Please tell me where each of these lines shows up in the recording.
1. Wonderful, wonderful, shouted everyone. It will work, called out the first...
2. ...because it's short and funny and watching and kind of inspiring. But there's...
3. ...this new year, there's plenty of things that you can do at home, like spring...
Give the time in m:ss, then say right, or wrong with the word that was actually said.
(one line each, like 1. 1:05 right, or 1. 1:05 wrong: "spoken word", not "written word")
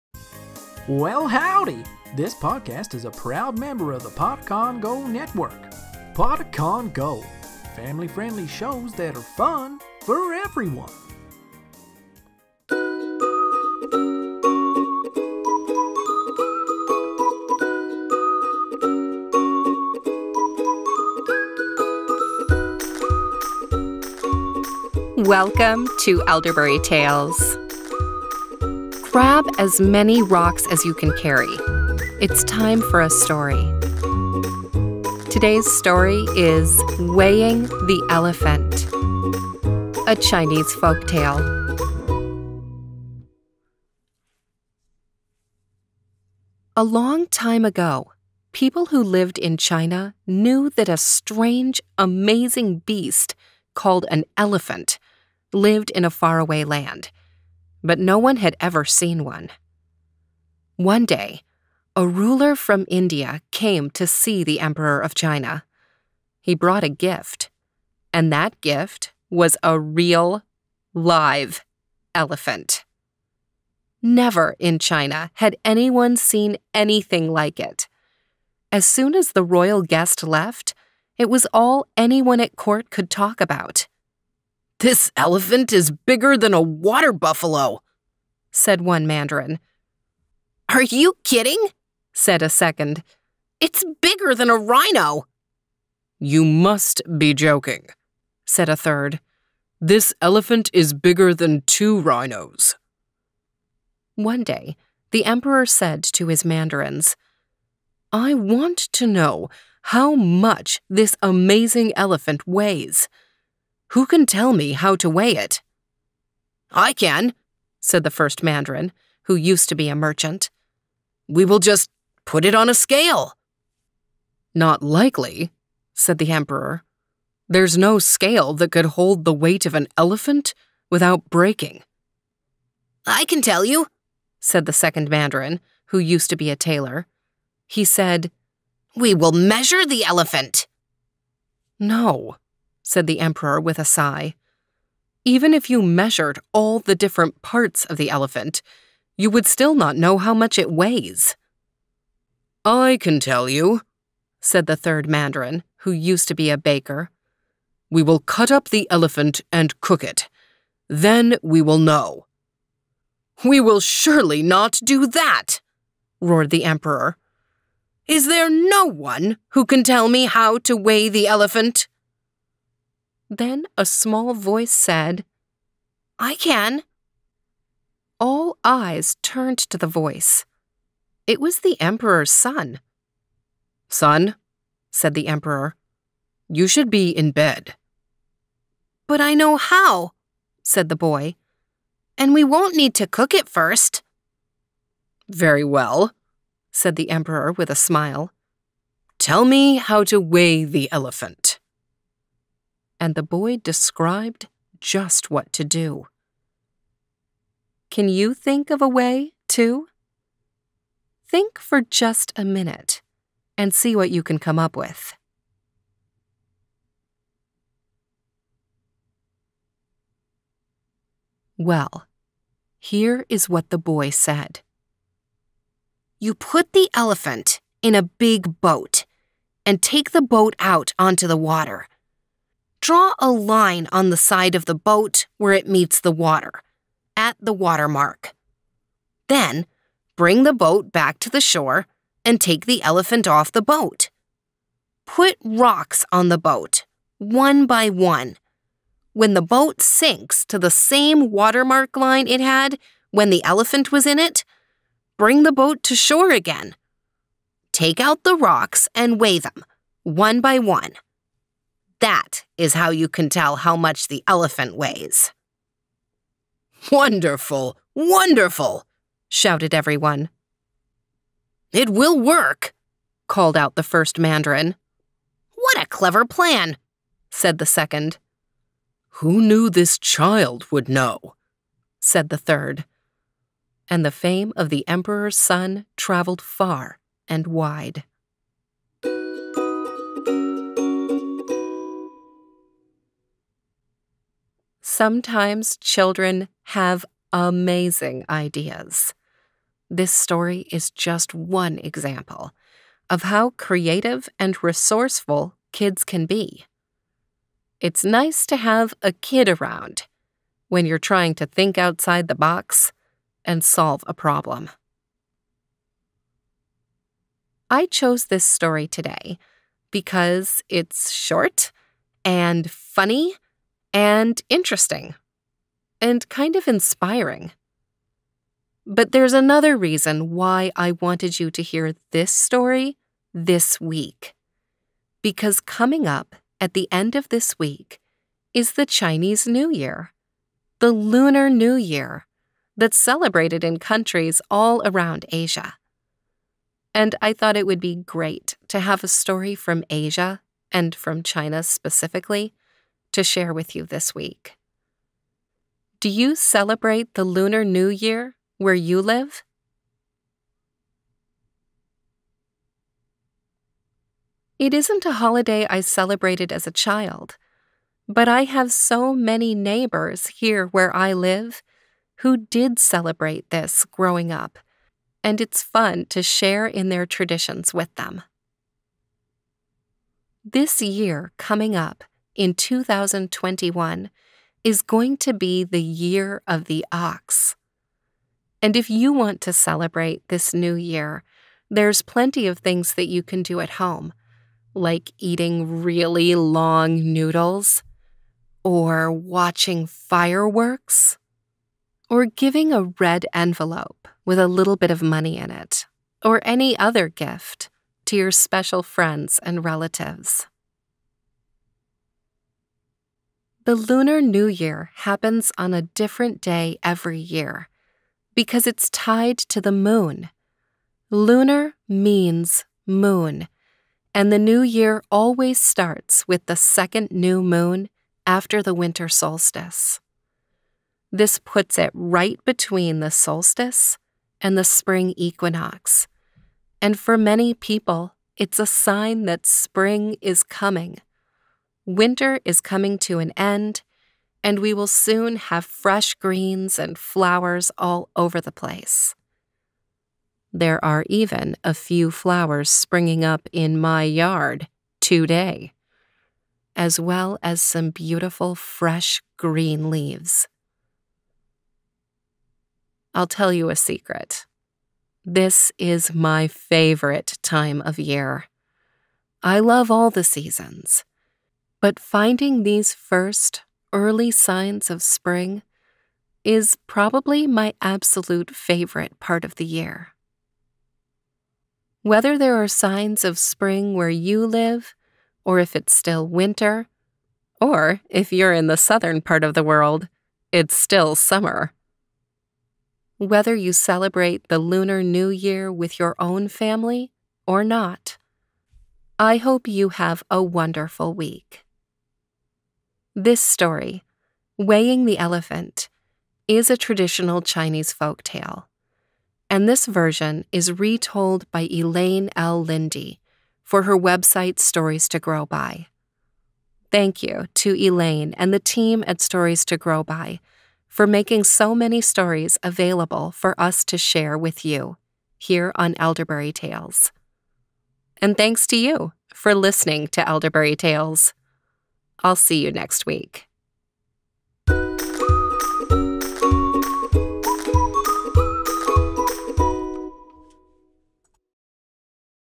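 1. 4:26 right
2. 5:19 wrong: "interesting", not "watching"
3. 6:30 wrong: "eating", not "spring".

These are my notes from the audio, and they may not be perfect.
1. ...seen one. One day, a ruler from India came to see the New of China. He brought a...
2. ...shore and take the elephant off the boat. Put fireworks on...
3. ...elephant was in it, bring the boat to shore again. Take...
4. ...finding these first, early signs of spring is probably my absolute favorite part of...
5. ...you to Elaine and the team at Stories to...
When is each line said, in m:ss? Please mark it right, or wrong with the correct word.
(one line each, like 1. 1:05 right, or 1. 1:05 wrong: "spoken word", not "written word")
1. 0:58 wrong: "Emperor", not "New"
2. 4:01 wrong: "rocks", not "fireworks"
3. 4:13 right
4. 7:51 right
5. 8:37 right.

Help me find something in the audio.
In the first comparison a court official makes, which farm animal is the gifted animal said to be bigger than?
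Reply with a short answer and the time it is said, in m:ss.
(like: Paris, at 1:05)
water buffalo, at 1:26.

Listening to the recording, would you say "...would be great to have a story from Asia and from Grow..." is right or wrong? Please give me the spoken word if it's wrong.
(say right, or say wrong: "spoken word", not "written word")
wrong: "China", not "Grow".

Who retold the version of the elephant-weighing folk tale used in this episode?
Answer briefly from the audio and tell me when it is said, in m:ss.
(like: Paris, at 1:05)
Elaine L. Lindy, at 8:31.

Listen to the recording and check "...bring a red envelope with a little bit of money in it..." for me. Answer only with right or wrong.
wrong.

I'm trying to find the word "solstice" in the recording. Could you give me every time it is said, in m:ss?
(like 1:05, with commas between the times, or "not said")
7:09, 7:13.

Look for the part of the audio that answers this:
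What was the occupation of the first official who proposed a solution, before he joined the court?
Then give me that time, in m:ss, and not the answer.
1:59.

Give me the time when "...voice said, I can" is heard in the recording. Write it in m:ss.
2:54.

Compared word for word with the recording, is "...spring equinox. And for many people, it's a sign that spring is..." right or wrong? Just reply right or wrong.
right.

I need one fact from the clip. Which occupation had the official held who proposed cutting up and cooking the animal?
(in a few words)
baker.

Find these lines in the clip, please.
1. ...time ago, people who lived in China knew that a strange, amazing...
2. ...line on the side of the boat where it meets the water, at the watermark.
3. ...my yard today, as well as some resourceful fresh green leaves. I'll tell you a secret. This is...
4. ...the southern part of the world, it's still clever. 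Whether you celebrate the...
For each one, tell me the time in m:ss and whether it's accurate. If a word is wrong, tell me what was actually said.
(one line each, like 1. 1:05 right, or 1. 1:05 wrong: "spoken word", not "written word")
1. 0:47 right
2. 3:53 right
3. 7:33 wrong: "beautiful", not "resourceful"
4. 8:08 wrong: "summer", not "clever".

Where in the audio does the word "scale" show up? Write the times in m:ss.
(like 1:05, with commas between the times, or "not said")
2:02, 2:07.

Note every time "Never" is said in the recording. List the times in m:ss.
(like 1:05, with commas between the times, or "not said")
1:14.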